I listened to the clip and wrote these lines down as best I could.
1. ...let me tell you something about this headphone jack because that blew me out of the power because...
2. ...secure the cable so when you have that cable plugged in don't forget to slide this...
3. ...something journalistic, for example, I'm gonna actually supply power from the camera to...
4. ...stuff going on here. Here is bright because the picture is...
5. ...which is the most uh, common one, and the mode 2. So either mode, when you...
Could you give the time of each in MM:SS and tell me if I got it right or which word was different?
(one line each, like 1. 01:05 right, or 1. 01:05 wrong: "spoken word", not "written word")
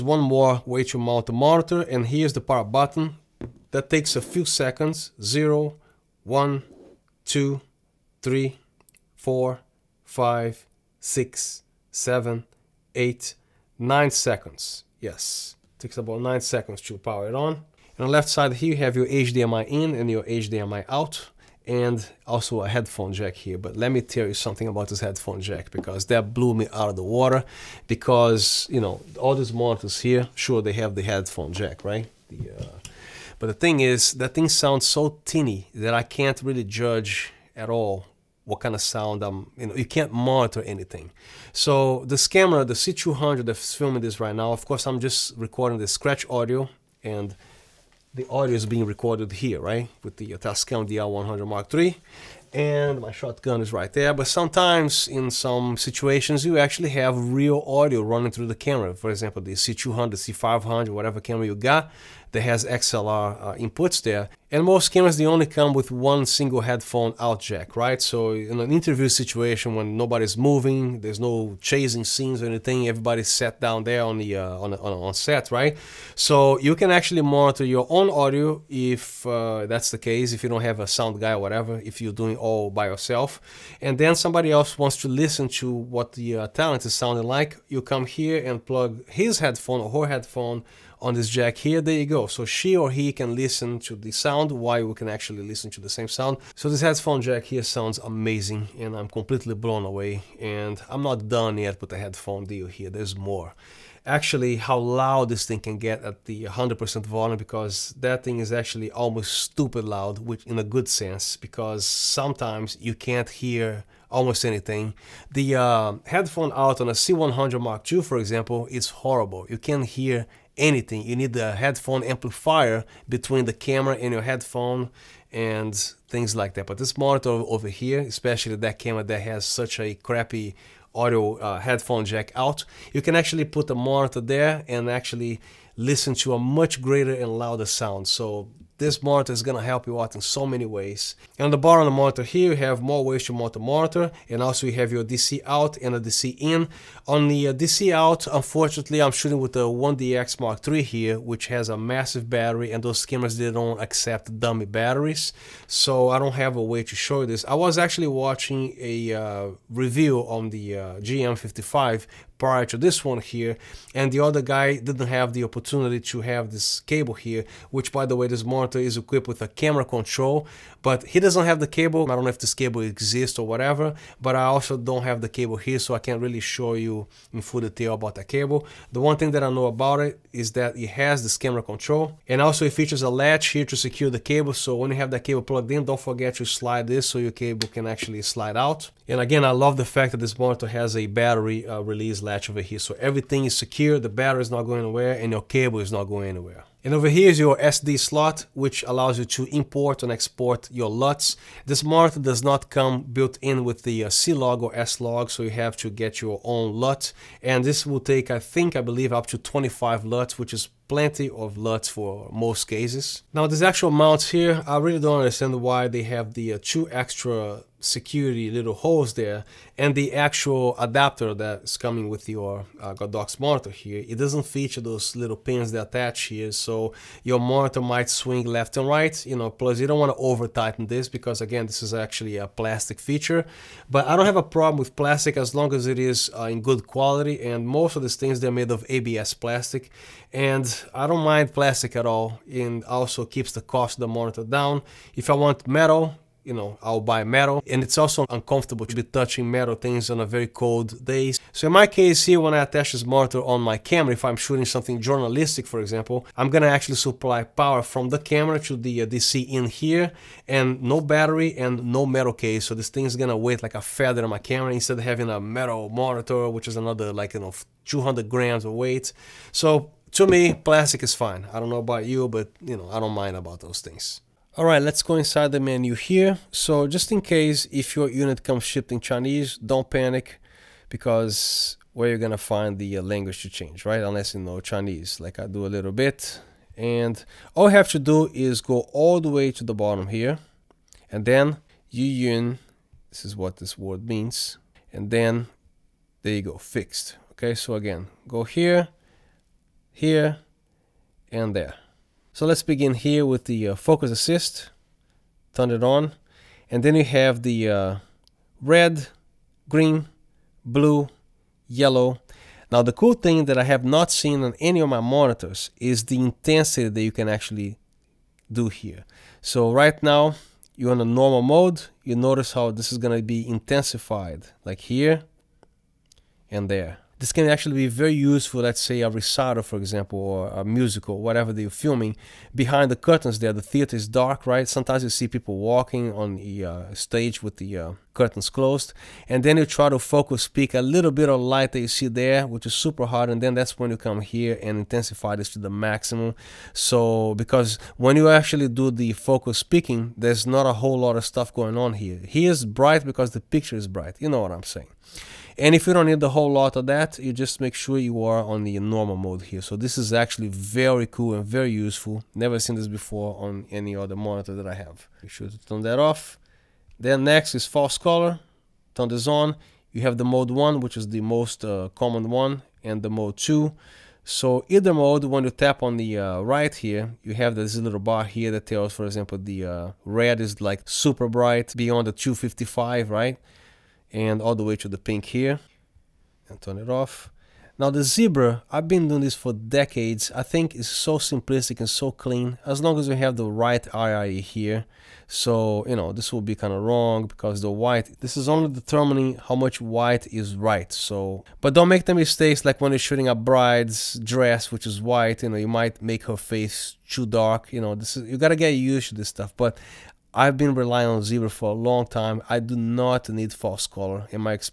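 1. 00:23 wrong: "water", not "power"
2. 03:03 right
3. 04:14 right
4. 05:51 right
5. 06:10 right.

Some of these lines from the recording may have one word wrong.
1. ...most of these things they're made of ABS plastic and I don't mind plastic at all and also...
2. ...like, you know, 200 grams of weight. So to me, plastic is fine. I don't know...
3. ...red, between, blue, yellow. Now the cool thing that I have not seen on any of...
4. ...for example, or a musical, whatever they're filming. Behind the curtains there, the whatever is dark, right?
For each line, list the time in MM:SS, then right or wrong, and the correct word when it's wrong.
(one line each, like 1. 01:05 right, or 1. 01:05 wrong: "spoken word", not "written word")
1. 03:57 right
2. 04:27 right
3. 05:08 wrong: "green", not "between"
4. 05:29 wrong: "theater", not "whatever".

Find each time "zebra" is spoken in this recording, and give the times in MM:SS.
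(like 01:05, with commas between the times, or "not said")
06:28, 06:51.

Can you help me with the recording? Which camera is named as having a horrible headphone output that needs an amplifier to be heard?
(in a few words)
C100 Mark II.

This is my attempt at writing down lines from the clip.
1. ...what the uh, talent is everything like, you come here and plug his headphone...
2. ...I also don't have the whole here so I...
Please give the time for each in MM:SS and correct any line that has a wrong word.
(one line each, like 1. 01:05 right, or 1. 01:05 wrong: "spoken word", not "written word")
1. 01:25 wrong: "sounding", not "everything"
2. 02:54 wrong: "cable", not "whole".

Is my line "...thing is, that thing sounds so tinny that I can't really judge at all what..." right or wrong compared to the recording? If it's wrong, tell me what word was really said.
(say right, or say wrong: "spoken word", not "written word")
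right.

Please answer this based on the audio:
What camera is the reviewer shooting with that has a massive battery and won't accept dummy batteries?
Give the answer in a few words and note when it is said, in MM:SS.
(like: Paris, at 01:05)
1DX Mark III, at 02:29.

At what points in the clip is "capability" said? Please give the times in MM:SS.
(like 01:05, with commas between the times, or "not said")
not said.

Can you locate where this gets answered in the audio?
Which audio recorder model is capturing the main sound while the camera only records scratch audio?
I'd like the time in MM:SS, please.
00:50.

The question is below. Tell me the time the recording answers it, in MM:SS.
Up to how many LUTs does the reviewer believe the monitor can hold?
03:29.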